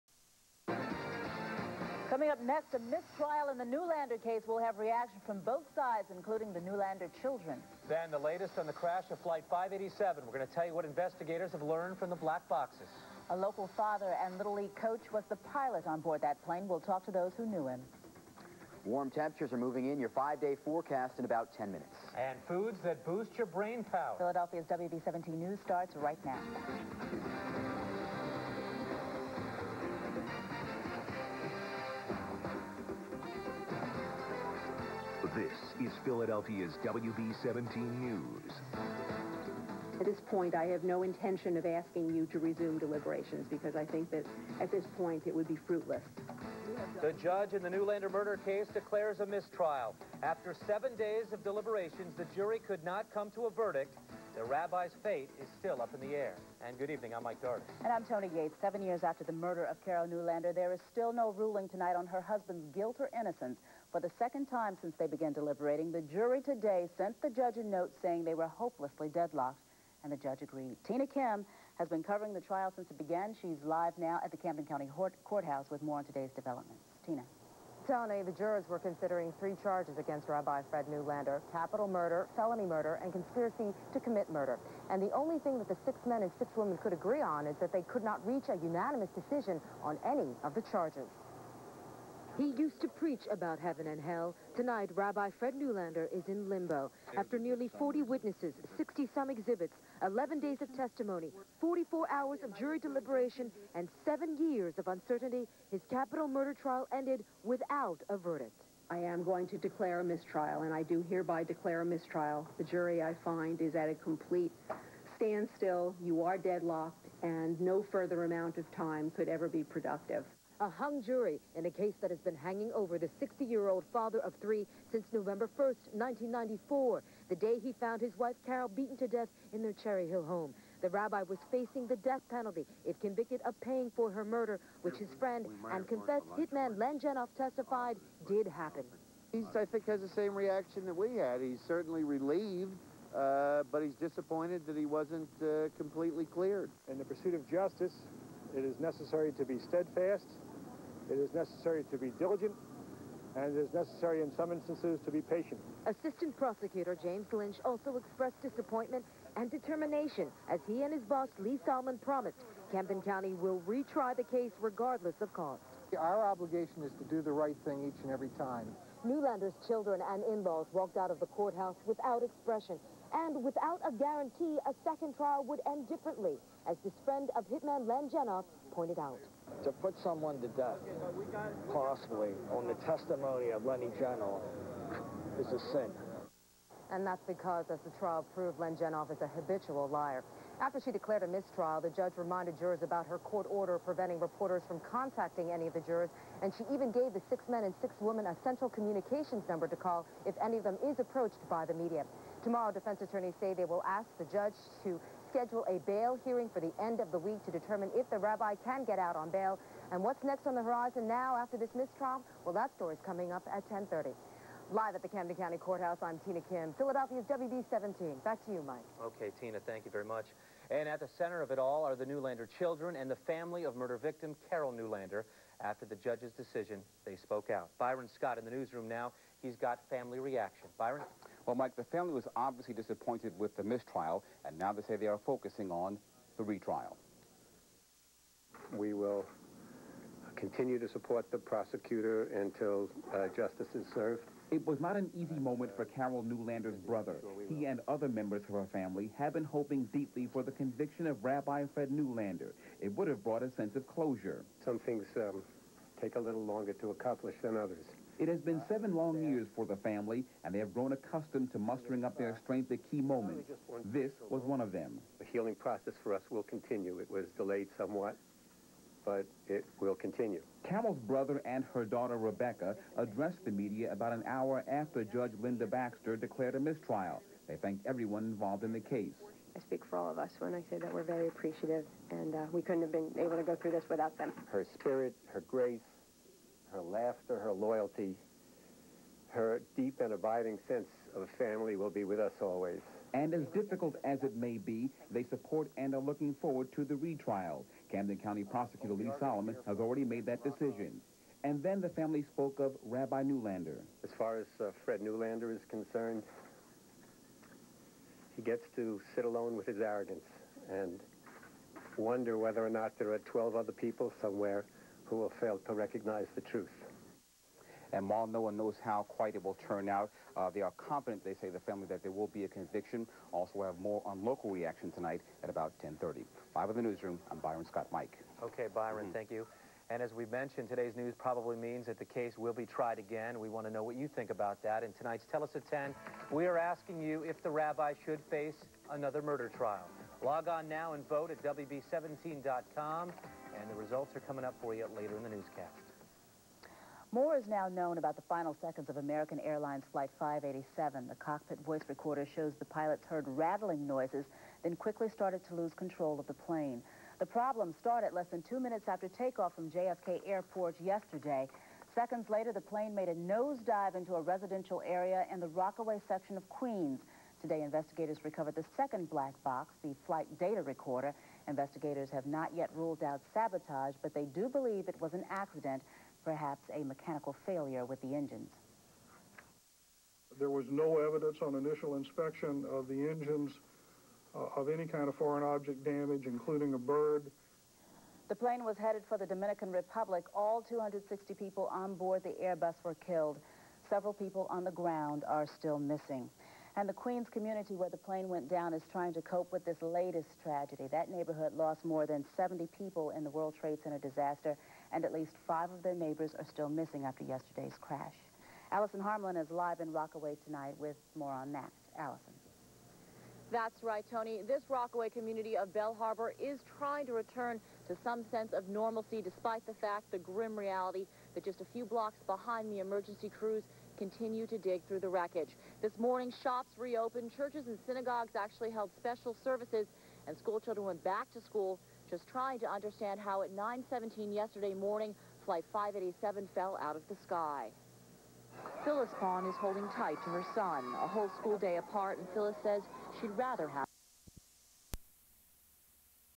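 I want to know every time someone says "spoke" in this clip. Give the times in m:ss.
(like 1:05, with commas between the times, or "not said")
3:47, 5:02.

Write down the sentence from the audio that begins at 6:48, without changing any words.
Allison Harmon is live in Rockaway tonight with more on that.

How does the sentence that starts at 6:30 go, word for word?
All 260 people on board the Airbus were killed.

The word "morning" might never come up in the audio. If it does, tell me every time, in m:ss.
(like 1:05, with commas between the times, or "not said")
7:05, 7:14.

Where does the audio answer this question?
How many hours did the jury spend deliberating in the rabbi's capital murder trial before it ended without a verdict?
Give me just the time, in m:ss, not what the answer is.
1:41.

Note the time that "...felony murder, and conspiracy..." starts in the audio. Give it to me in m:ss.
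1:22.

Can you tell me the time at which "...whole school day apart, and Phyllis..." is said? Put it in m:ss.
7:21.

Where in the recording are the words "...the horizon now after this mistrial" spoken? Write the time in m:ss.
3:30.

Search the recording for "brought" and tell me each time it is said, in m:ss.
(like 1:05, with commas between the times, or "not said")
4:13.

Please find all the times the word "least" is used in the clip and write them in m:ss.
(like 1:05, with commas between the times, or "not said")
6:45.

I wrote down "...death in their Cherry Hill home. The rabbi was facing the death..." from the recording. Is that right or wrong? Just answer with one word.
right.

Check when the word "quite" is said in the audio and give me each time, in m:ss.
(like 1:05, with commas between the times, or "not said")
5:19.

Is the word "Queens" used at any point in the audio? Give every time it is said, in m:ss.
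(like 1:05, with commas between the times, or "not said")
6:06, 6:36.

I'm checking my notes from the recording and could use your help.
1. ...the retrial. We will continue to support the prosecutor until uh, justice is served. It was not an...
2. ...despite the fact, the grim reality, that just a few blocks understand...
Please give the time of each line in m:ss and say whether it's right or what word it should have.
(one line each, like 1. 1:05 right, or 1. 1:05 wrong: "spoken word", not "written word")
1. 3:56 right
2. 6:59 wrong: "behind", not "understand".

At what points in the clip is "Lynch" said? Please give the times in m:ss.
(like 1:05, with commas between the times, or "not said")
2:37.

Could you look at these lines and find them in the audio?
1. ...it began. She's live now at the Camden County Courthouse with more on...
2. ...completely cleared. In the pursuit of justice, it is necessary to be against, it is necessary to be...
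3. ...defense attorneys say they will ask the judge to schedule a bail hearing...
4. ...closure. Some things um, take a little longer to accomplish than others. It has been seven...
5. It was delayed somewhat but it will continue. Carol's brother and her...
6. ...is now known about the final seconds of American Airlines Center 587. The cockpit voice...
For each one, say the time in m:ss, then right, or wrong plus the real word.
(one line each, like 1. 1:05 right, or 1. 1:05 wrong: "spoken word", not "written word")
1. 1:12 right
2. 2:25 wrong: "steadfast", not "against"
3. 3:22 right
4. 4:13 right
5. 4:26 right
6. 5:47 wrong: "Flight", not "Center".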